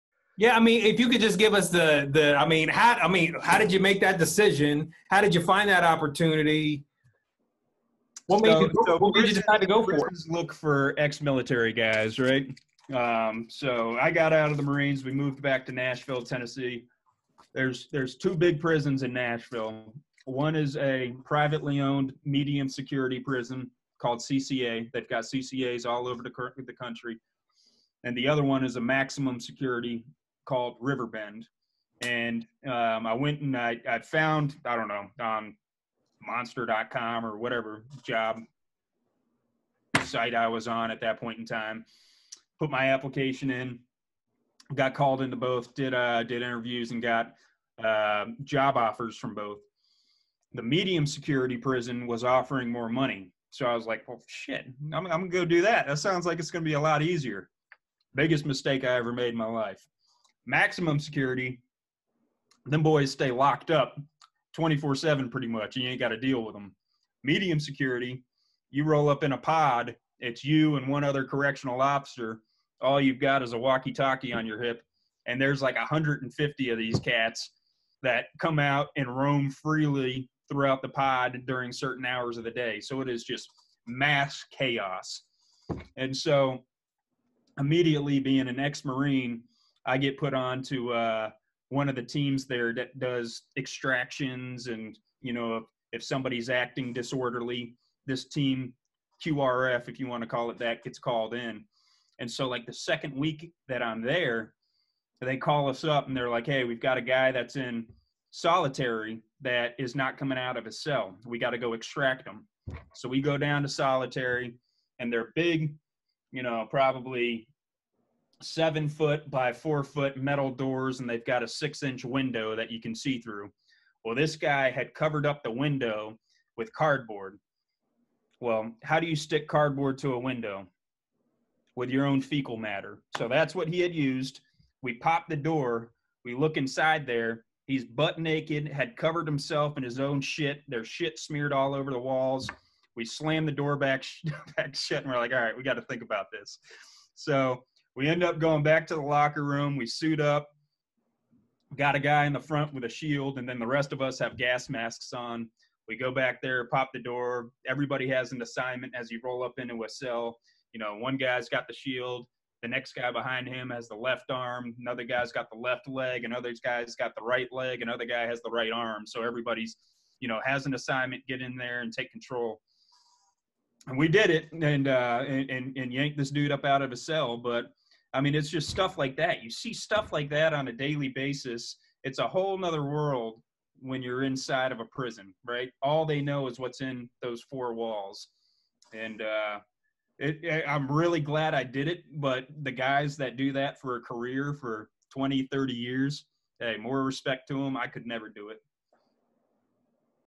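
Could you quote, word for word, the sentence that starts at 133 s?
So that's what he had used.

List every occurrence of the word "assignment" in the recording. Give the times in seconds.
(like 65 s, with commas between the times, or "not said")
158 s, 170 s.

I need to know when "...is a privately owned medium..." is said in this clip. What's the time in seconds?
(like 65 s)
20 s.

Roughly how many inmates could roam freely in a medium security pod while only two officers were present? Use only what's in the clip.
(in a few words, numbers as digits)
150.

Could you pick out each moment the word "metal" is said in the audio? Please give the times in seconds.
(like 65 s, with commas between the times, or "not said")
120 s.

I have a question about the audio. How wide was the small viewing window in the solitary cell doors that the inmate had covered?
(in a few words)
6 inches.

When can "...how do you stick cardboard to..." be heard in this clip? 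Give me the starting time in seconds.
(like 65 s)
128 s.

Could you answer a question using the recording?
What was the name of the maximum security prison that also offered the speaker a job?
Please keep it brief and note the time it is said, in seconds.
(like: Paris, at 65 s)
Riverbend, at 30 s.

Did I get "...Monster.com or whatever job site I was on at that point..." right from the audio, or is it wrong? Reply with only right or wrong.
right.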